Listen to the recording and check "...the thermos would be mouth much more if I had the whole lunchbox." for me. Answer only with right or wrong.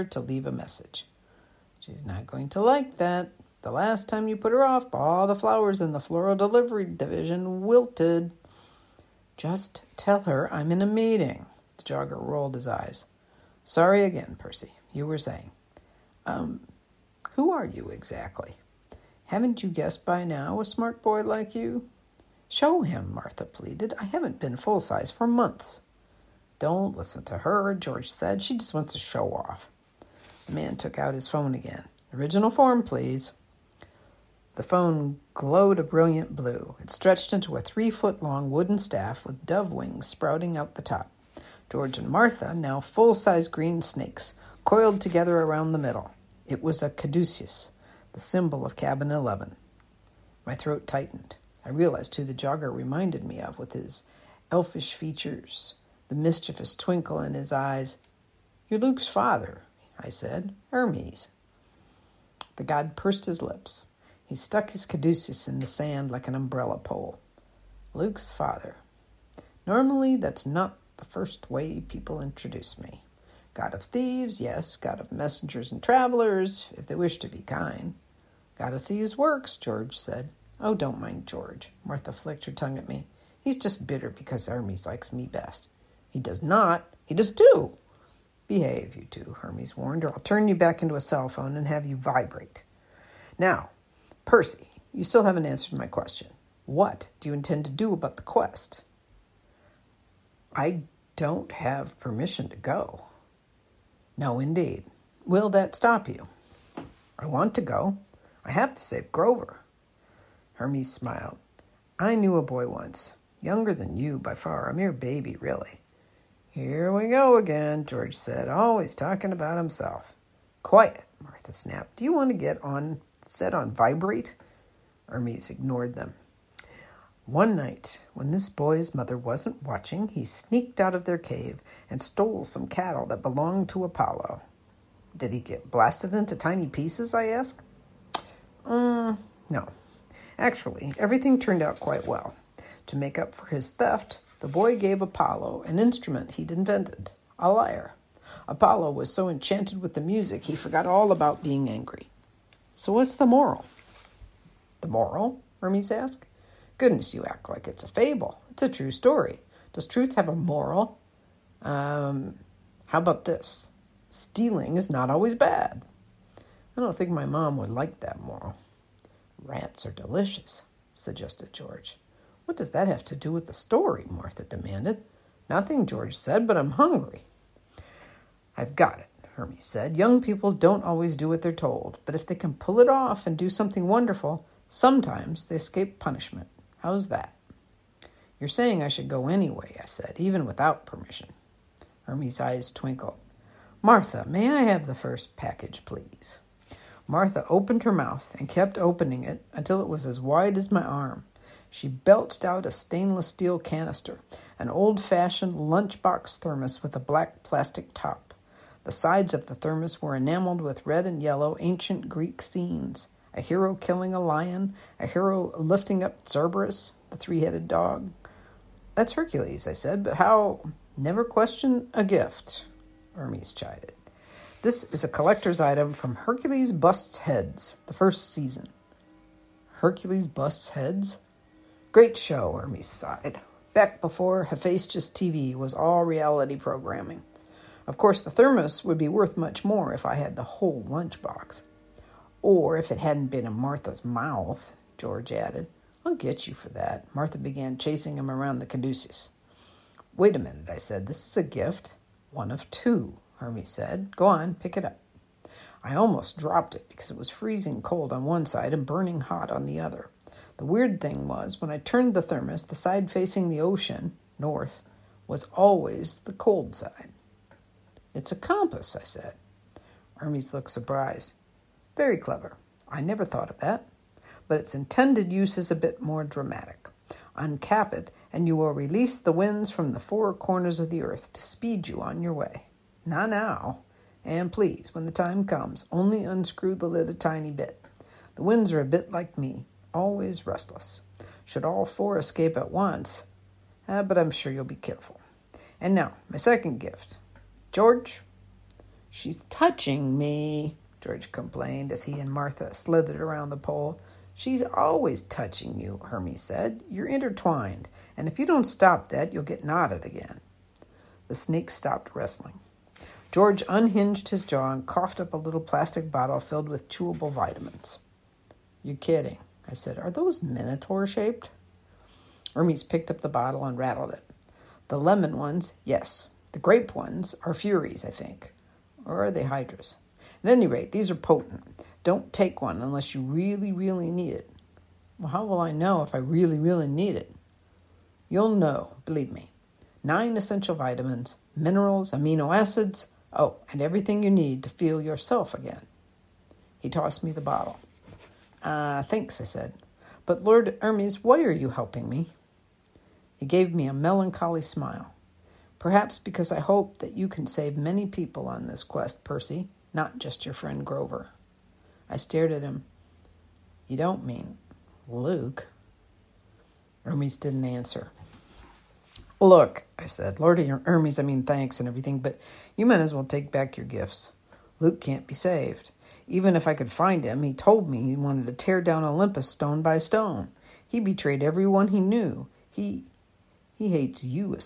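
wrong.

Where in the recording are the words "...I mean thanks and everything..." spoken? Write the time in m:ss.
6:11.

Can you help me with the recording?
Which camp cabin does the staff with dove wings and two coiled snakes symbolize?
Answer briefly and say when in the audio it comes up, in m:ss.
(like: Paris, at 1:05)
Cabin 11, at 0:48.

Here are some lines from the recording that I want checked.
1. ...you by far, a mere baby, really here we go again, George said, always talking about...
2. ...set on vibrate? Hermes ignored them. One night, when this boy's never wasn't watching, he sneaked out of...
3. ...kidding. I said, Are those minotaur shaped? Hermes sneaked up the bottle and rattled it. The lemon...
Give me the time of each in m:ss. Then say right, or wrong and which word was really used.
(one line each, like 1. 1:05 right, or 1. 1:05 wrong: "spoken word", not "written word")
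1. 1:53 right
2. 2:03 wrong: "mother", not "never"
3. 5:18 wrong: "picked", not "sneaked".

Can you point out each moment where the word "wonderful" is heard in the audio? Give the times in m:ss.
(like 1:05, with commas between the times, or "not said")
3:03.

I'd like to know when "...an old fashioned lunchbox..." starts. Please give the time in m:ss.
3:24.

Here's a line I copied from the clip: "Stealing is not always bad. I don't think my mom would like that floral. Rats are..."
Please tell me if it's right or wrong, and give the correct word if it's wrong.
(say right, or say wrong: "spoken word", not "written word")
wrong: "moral", not "floral".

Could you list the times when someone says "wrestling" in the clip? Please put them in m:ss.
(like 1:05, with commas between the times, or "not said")
5:12.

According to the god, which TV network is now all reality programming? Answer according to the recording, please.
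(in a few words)
Hephaestus TV.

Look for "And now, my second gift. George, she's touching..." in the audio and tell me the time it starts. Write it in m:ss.
4:55.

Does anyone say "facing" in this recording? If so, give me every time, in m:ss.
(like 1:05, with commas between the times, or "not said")
4:23.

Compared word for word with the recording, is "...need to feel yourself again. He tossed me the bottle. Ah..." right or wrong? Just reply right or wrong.
right.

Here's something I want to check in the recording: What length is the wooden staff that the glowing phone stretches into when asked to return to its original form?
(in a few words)
3 feet.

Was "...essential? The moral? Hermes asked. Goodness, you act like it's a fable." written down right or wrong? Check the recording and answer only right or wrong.
wrong.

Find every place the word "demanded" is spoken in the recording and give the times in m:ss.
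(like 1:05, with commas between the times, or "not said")
2:54.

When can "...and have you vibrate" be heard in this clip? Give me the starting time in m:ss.
1:31.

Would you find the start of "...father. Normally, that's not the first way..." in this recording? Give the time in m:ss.
1:08.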